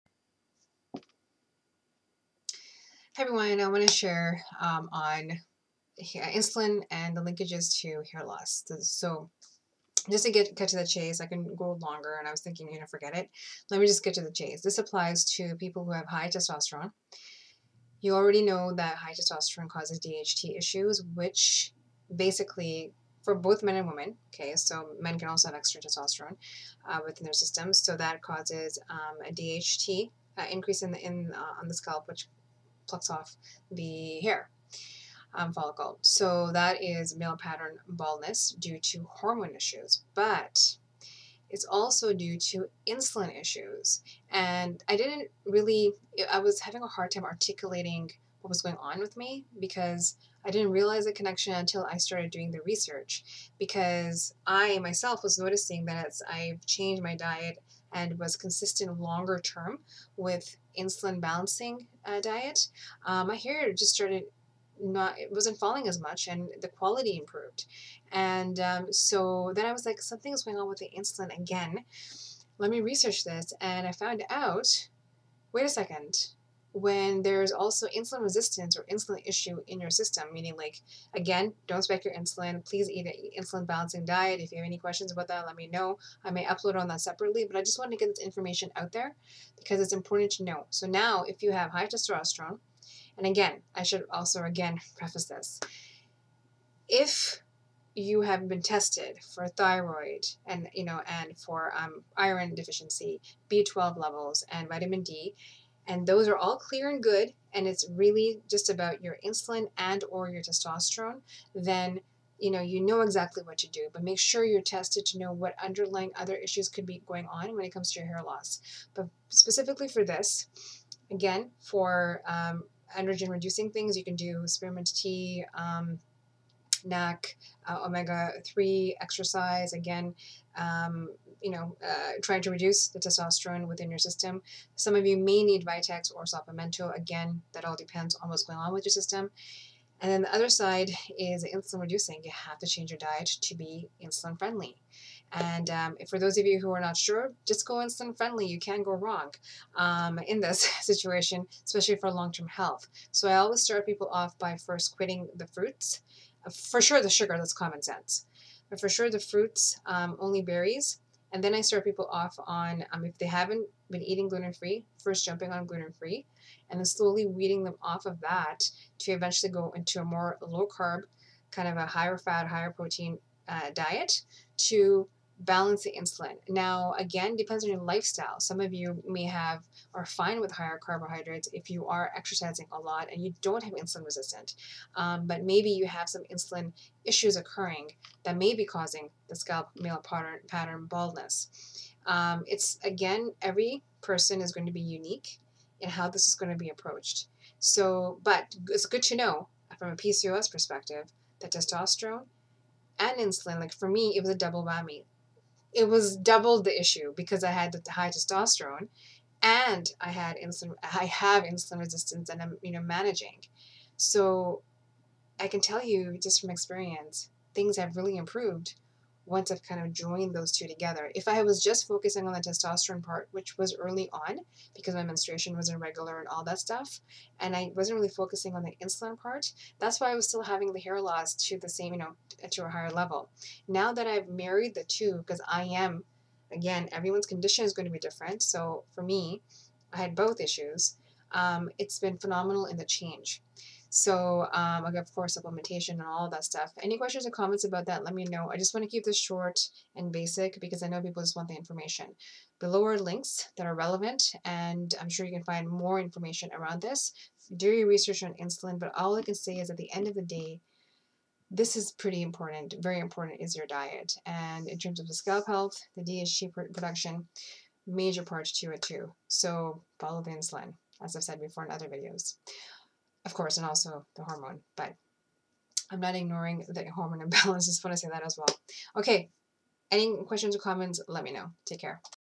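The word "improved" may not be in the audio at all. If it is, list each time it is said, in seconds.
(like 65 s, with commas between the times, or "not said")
67 s, 218 s.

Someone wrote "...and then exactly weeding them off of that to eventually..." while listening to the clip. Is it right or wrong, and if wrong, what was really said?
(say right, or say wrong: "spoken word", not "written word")
wrong: "slowly", not "exactly".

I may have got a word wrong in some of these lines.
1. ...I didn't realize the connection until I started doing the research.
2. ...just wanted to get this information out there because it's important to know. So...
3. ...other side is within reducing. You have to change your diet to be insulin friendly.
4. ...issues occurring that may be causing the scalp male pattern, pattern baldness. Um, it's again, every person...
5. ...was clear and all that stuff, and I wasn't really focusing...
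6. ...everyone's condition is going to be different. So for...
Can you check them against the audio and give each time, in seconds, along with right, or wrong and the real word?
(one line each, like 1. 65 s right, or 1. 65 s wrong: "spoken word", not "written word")
1. 50 s right
2. 87 s right
3. 140 s wrong: "insulin", not "within"
4. 187 s right
5. 225 s wrong: "irregular", not "clear"
6. 236 s right.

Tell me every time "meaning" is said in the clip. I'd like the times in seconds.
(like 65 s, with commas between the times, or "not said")
80 s.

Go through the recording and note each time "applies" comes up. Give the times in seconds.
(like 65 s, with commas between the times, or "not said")
14 s.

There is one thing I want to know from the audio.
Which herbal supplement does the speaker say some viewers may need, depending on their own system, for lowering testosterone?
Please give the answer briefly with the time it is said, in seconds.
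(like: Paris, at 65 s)
Vitex, at 135 s.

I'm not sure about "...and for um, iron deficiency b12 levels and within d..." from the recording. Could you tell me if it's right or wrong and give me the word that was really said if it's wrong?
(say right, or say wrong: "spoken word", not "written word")
wrong: "vitamin", not "within".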